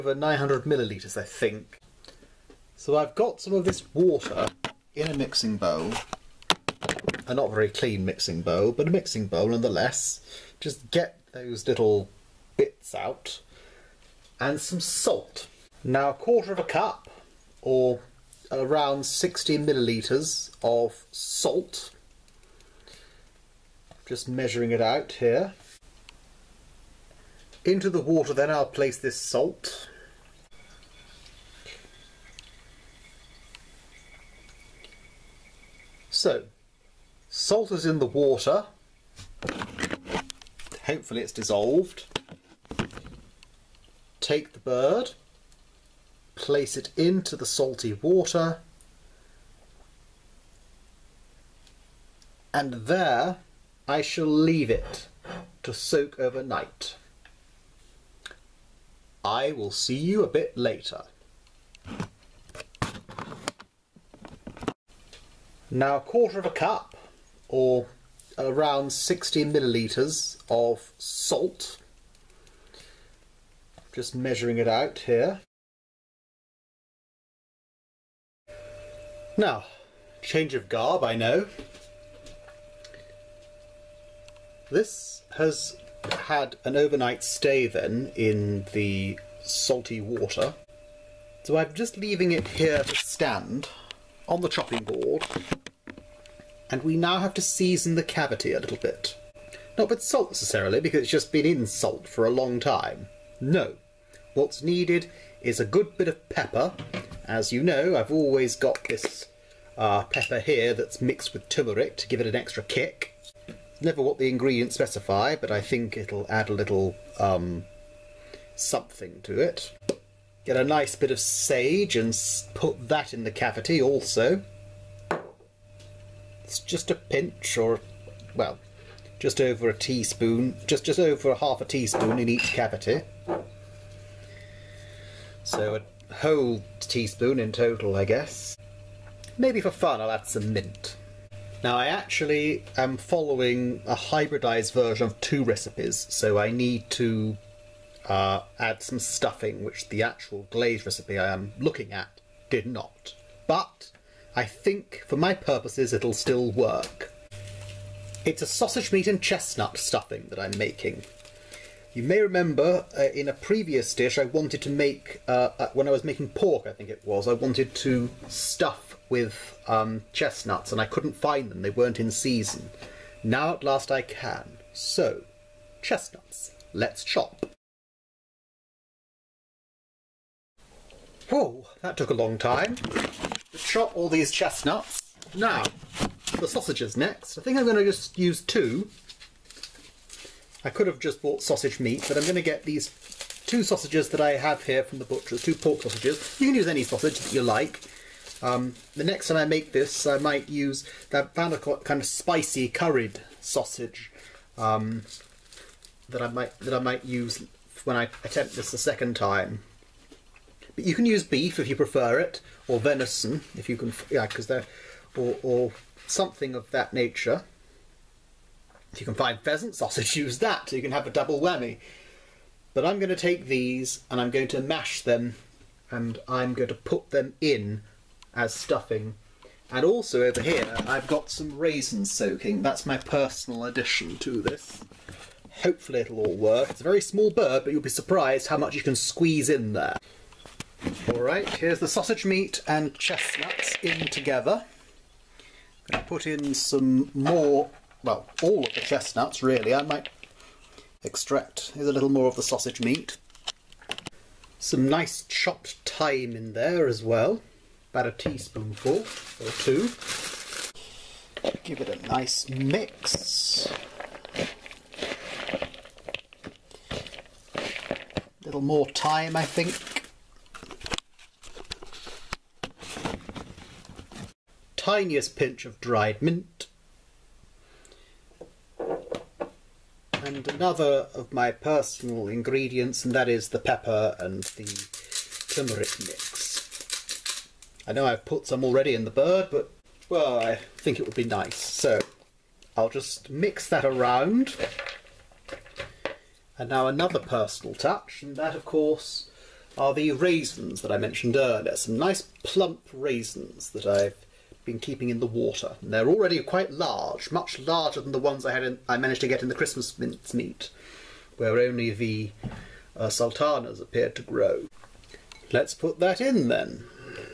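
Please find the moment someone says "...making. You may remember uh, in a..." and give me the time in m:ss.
2:40.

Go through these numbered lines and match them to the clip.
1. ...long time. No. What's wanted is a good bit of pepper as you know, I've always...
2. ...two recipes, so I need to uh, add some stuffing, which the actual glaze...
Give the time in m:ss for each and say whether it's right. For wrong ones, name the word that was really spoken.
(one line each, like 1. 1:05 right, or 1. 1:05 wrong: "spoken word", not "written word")
1. 1:42 wrong: "needed", not "wanted"
2. 2:25 right.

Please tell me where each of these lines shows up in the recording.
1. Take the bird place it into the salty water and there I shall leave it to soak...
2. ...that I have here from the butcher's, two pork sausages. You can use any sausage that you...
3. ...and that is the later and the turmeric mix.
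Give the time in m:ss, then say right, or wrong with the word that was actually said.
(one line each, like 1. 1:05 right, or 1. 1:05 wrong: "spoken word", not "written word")
1. 0:44 right
2. 3:14 right
3. 4:43 wrong: "pepper", not "later".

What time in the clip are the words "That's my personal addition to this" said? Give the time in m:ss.
3:52.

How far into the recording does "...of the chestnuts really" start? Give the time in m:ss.
4:08.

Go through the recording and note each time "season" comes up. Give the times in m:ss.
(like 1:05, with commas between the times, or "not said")
1:37, 2:52.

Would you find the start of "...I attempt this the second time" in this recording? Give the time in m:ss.
3:27.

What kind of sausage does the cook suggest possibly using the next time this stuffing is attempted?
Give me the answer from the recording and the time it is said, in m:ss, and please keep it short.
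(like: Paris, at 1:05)
spicy curried sausage, at 3:22.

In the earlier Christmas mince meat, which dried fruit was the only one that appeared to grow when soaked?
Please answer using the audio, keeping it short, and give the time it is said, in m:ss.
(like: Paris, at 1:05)
sultanas, at 5:13.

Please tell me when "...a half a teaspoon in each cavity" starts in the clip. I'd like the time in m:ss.
2:11.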